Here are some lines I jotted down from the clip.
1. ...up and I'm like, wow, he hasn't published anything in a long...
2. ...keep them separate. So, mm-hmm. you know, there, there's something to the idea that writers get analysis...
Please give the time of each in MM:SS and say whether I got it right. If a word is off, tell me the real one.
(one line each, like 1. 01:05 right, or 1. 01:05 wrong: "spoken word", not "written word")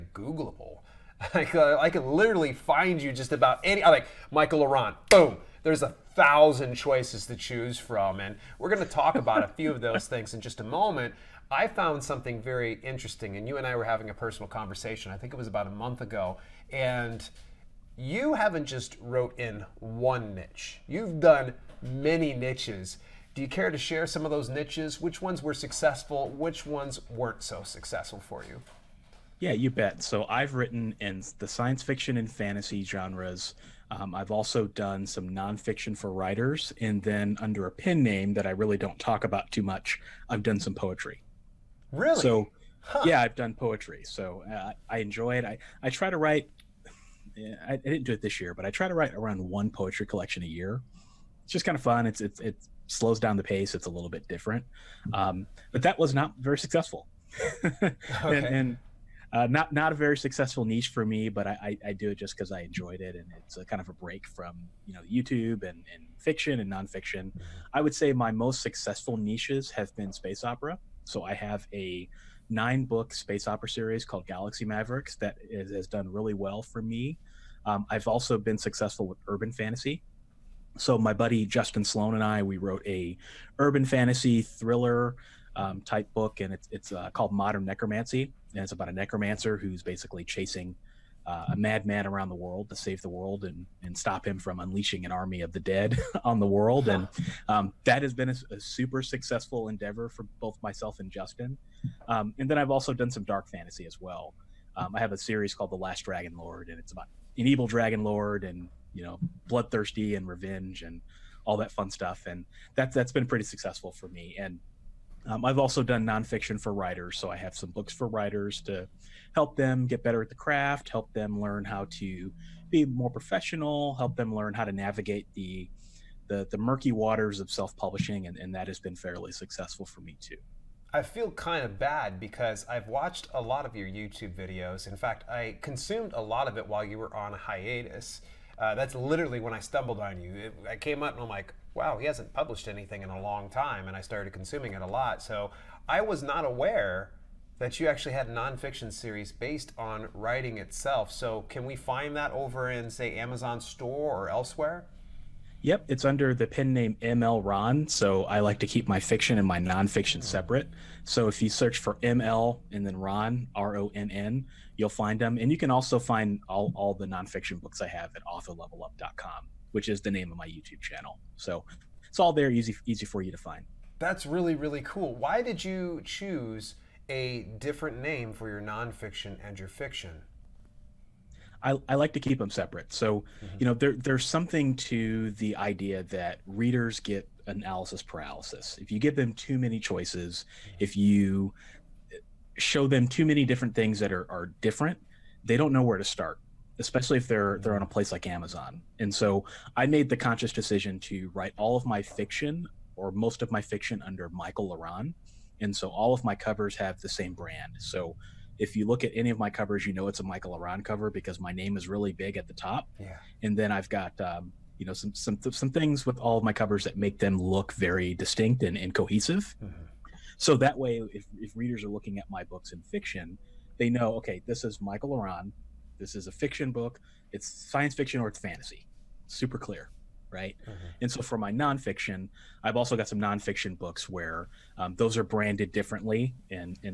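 1. 02:21 right
2. 03:02 wrong: "readers", not "writers".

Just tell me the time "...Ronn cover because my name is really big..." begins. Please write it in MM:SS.
03:30.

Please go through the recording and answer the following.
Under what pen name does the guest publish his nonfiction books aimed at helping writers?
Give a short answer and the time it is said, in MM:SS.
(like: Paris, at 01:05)
ML Ronn, at 02:37.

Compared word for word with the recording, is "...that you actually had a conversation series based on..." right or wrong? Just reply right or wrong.
wrong.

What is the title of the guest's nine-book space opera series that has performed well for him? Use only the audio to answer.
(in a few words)
Galaxy Mavericks.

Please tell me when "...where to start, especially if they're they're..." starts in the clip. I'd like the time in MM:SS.
03:15.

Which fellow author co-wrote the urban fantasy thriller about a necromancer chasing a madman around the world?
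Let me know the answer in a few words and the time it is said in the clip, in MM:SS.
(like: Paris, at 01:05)
Justin Sloan, at 01:21.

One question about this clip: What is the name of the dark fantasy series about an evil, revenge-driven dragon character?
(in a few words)
The Last Dragon Lord.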